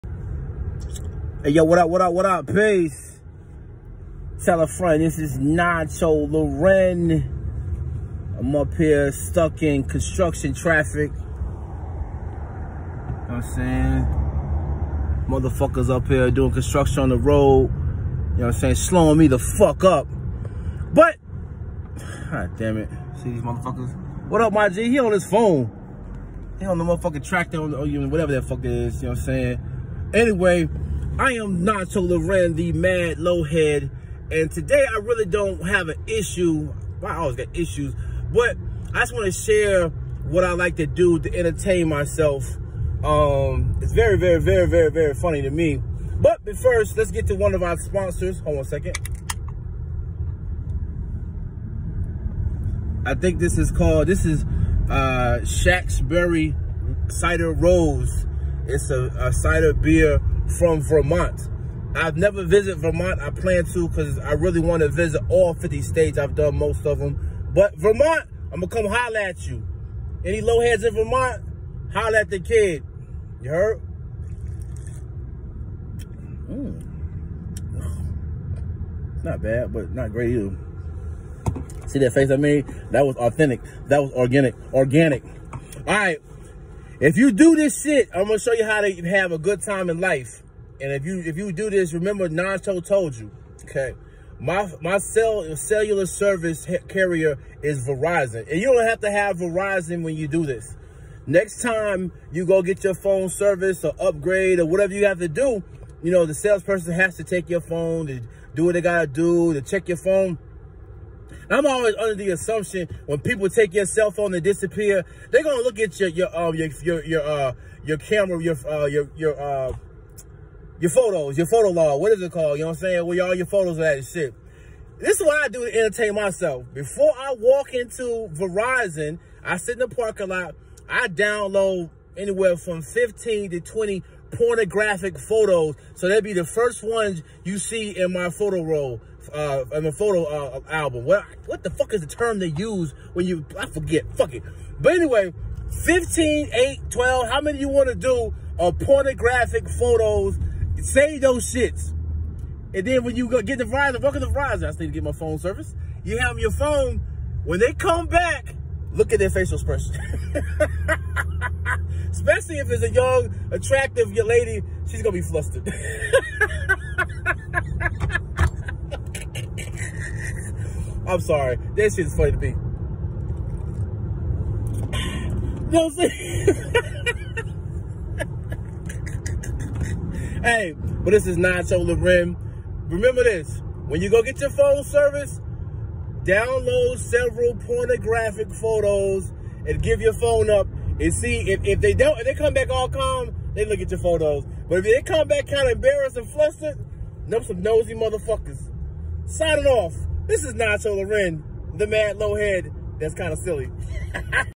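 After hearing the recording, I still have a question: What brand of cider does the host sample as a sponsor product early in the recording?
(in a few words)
Shacksbury Cider Rose.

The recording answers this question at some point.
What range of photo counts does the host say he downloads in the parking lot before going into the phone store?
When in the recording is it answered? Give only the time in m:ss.
2:12.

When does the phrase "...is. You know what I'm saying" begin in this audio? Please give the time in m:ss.
0:28.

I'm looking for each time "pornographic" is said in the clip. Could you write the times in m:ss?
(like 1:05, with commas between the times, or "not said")
2:14, 2:28, 3:07.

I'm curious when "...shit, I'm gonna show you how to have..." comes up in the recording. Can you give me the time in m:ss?
1:27.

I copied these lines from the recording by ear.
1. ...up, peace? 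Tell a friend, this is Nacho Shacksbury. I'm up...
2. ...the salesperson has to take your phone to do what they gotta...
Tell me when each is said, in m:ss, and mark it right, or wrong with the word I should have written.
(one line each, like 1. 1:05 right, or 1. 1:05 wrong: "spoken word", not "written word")
1. 0:02 wrong: "Loren", not "Shacksbury"
2. 1:46 right.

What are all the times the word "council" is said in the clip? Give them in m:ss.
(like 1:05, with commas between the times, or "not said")
not said.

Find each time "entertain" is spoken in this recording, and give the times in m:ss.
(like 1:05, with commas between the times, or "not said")
0:41, 2:05.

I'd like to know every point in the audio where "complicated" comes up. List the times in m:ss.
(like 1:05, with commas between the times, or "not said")
not said.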